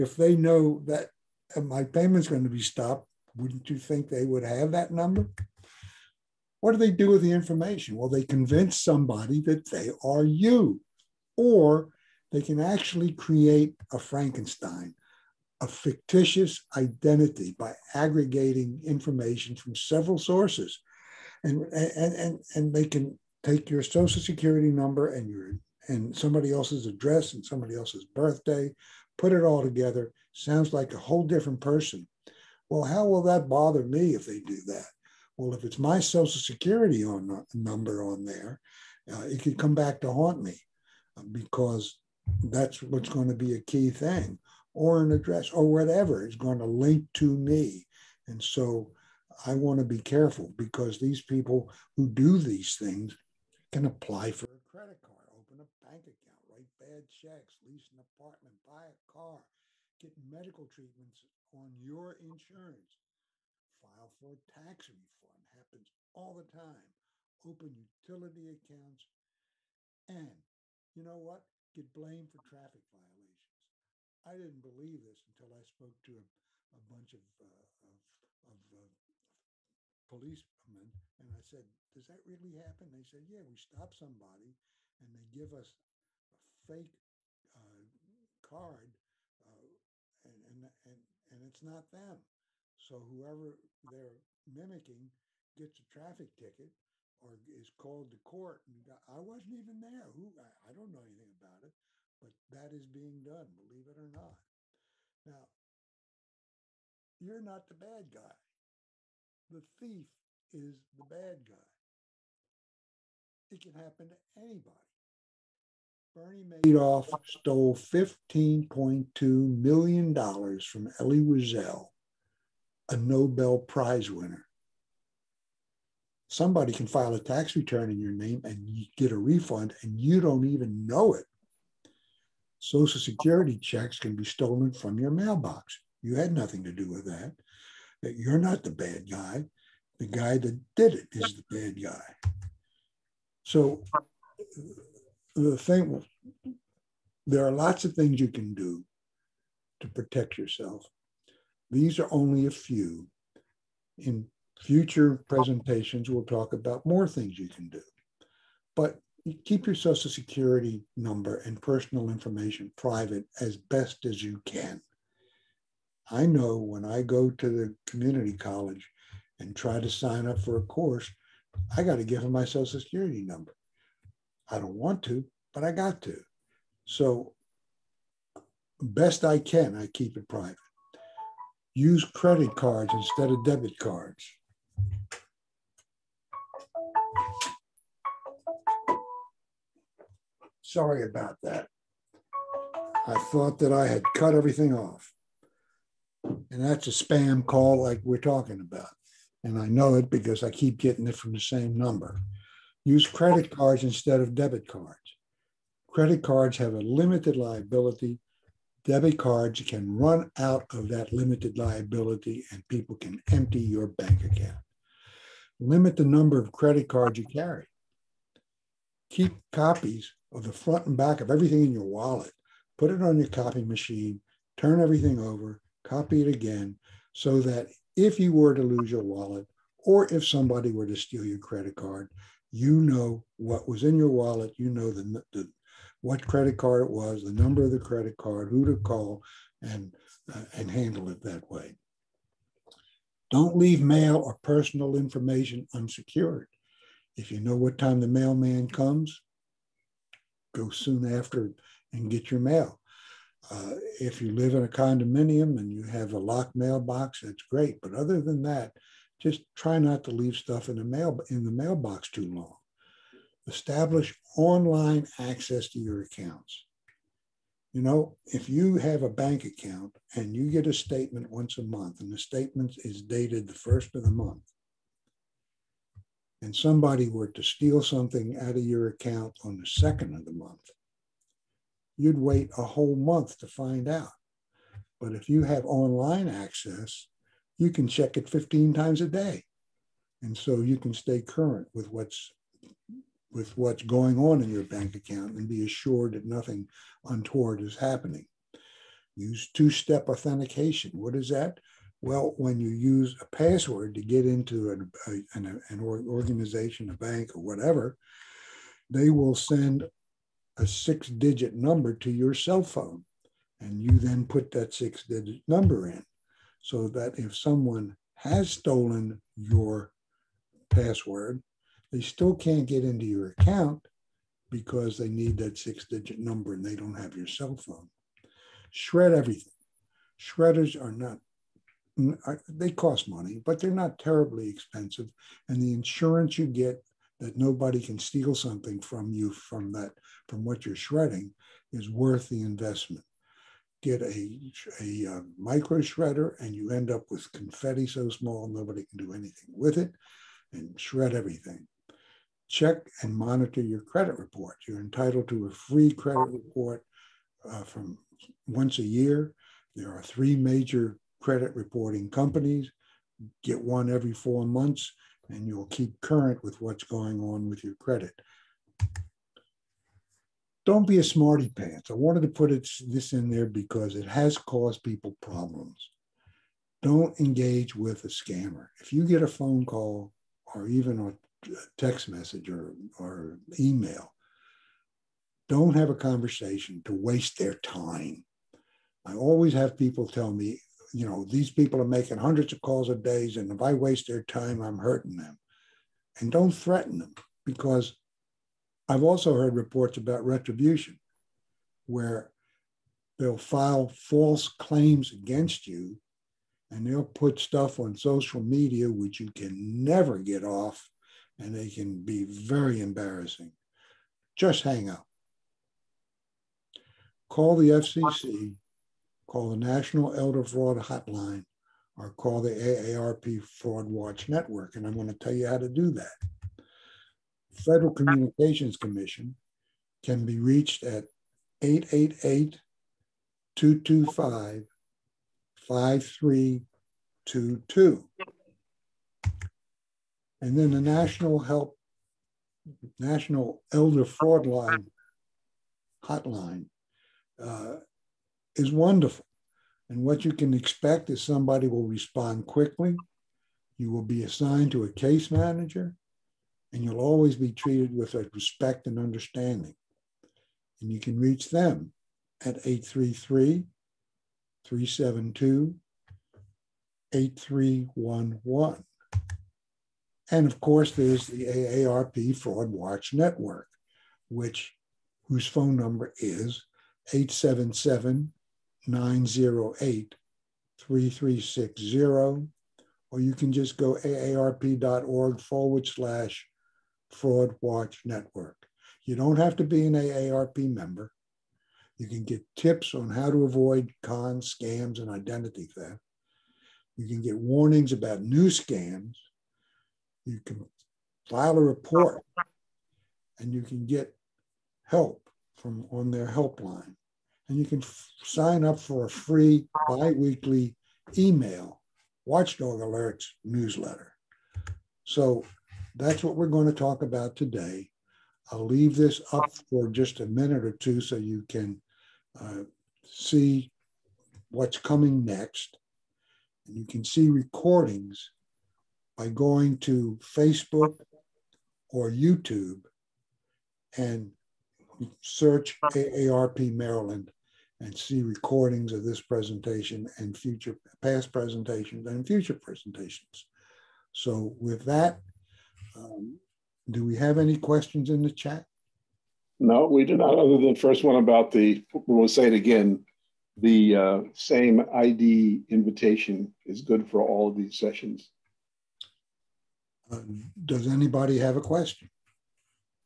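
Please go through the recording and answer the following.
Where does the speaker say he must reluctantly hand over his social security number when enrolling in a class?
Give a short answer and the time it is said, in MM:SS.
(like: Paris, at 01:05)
community college, at 02:47.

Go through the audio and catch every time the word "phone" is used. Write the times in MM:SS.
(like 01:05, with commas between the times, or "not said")
05:12, 05:27, 06:19, 07:55.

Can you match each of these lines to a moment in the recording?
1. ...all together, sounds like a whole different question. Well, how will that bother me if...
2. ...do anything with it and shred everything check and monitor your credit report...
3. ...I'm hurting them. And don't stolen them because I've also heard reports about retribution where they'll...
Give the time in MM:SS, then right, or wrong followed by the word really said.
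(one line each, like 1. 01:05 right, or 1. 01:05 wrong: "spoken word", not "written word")
1. 00:29 wrong: "person", not "question"
2. 05:49 right
3. 06:34 wrong: "threaten", not "stolen".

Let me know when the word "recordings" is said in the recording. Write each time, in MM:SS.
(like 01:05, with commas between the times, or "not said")
08:47, 08:58.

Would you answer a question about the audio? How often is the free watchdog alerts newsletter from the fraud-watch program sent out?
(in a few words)
biweekly.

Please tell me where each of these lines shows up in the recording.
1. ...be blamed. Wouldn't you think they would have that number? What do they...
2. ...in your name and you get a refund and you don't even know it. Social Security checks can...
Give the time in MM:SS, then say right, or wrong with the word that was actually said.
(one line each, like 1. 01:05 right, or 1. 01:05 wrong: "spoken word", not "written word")
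1. 00:02 wrong: "stopped", not "blamed"
2. 02:07 right.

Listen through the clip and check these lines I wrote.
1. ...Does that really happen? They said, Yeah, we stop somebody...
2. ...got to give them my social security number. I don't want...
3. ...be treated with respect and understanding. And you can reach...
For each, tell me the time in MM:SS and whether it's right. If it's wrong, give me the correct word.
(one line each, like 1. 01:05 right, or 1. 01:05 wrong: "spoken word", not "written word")
1. 01:21 right
2. 02:51 right
3. 07:37 right.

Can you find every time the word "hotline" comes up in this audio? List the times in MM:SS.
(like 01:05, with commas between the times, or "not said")
07:00, 07:26.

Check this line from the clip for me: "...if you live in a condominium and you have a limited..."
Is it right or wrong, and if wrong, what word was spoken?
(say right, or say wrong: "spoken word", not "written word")
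wrong: "locked", not "limited".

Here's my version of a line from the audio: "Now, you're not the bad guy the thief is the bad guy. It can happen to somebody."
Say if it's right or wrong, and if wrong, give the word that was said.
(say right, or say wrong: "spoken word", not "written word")
wrong: "anybody", not "somebody".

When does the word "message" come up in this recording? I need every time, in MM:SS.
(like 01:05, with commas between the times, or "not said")
06:22.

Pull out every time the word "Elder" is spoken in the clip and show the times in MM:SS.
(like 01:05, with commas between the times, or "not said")
07:00, 07:23.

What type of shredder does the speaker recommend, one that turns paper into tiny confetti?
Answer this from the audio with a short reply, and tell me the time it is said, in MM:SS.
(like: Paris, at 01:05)
micro shredder, at 05:45.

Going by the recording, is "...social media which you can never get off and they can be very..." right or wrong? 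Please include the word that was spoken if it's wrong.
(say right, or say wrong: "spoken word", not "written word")
right.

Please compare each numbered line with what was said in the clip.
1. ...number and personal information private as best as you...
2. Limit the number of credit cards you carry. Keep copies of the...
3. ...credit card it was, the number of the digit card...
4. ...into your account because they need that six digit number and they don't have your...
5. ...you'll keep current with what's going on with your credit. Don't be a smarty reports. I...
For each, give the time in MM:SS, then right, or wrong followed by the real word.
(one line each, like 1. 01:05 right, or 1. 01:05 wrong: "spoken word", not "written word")
1. 02:40 right
2. 03:35 right
3. 03:56 wrong: "credit", not "digit"
4. 05:22 right
5. 06:05 wrong: "pants", not "reports".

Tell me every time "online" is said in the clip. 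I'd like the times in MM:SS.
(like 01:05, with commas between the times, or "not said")
04:24, 04:45.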